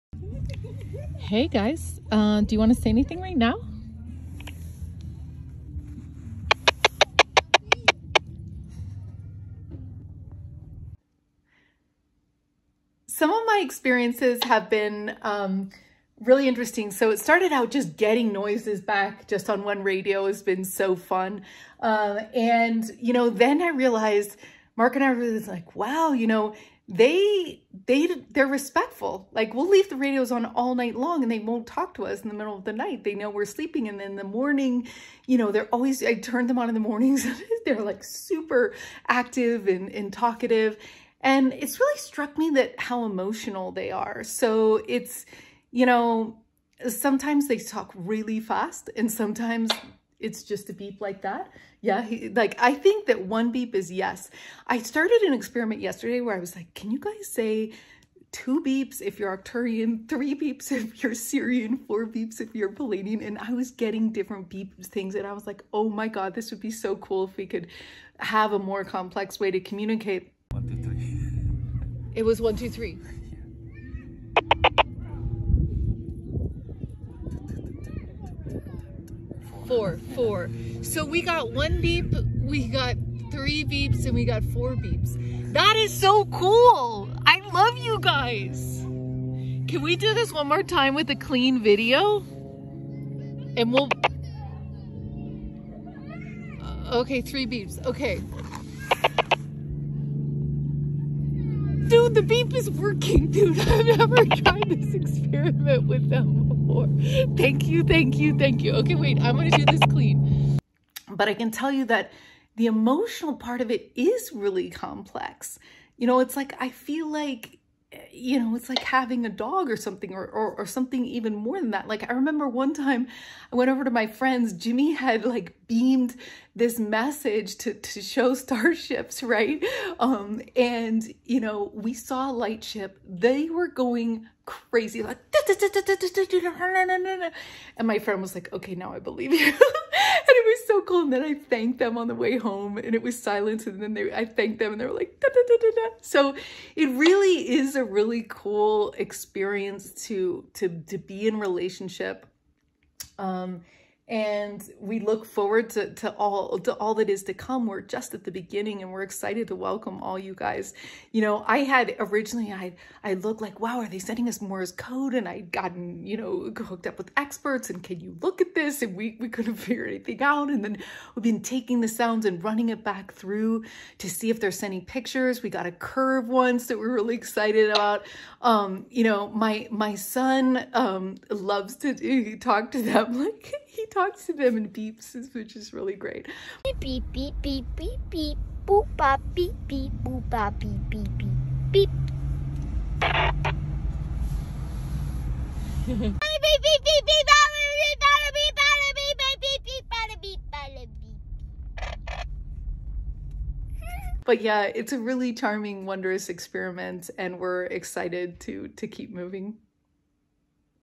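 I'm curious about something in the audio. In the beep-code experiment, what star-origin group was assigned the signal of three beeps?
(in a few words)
Sirian.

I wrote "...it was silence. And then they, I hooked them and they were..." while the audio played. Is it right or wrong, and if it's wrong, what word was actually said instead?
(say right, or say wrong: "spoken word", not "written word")
wrong: "thanked", not "hooked".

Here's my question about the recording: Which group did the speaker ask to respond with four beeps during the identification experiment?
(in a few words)
Pleiadian.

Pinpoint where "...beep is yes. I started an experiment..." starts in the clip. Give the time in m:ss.
0:53.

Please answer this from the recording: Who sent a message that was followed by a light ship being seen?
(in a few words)
Jimmy.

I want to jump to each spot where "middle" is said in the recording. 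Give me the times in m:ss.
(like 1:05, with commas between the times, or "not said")
0:32.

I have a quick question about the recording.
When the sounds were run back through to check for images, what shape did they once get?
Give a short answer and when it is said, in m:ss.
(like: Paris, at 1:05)
A curve, at 2:55.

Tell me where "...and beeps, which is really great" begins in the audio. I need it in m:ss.
3:04.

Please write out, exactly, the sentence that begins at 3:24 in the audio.
but yeah, it's a really charming, wondrous experiment, and we're excited to to keep moving.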